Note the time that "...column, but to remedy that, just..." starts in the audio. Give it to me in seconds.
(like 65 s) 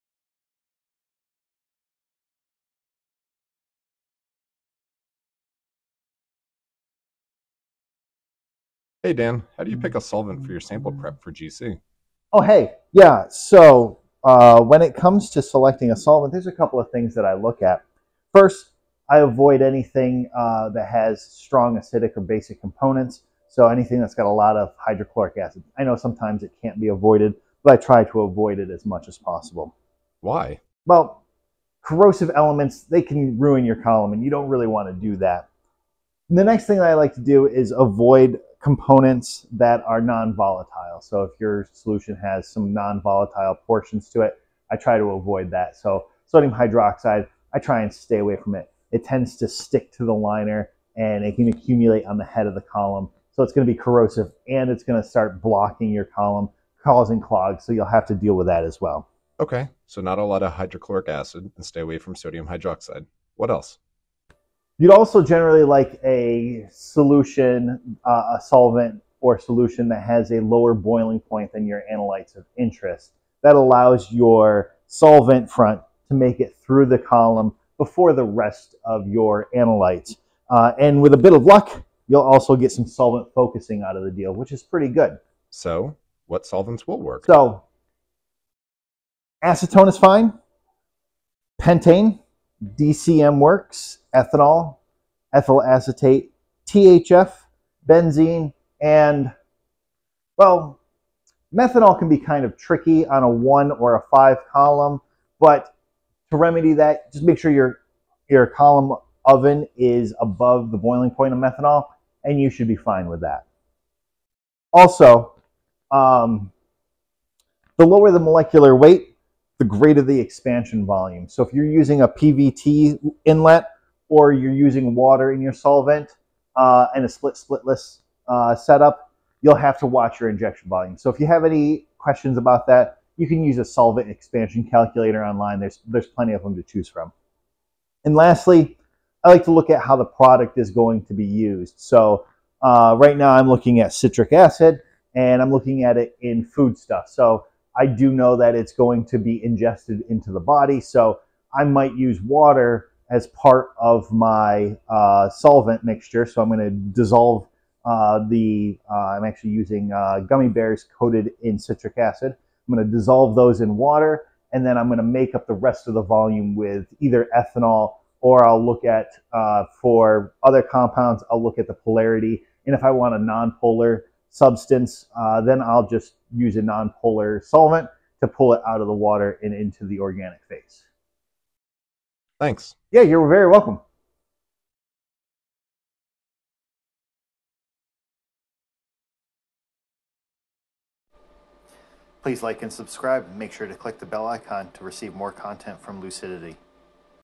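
104 s.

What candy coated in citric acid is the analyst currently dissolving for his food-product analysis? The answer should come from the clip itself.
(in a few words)
gummy bears.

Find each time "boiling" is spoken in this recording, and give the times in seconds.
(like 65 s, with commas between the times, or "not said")
70 s, 110 s.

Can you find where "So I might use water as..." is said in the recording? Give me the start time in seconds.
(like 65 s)
150 s.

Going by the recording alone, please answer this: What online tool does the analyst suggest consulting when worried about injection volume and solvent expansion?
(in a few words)
solvent expansion calculator.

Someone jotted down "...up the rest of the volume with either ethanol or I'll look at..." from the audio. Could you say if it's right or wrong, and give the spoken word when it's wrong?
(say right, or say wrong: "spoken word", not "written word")
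right.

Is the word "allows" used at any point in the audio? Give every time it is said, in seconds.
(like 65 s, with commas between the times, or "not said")
73 s.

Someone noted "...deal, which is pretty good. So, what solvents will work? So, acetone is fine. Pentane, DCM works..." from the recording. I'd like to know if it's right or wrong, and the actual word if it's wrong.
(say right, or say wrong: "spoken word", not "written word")
right.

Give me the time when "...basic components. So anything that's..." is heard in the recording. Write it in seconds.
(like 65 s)
22 s.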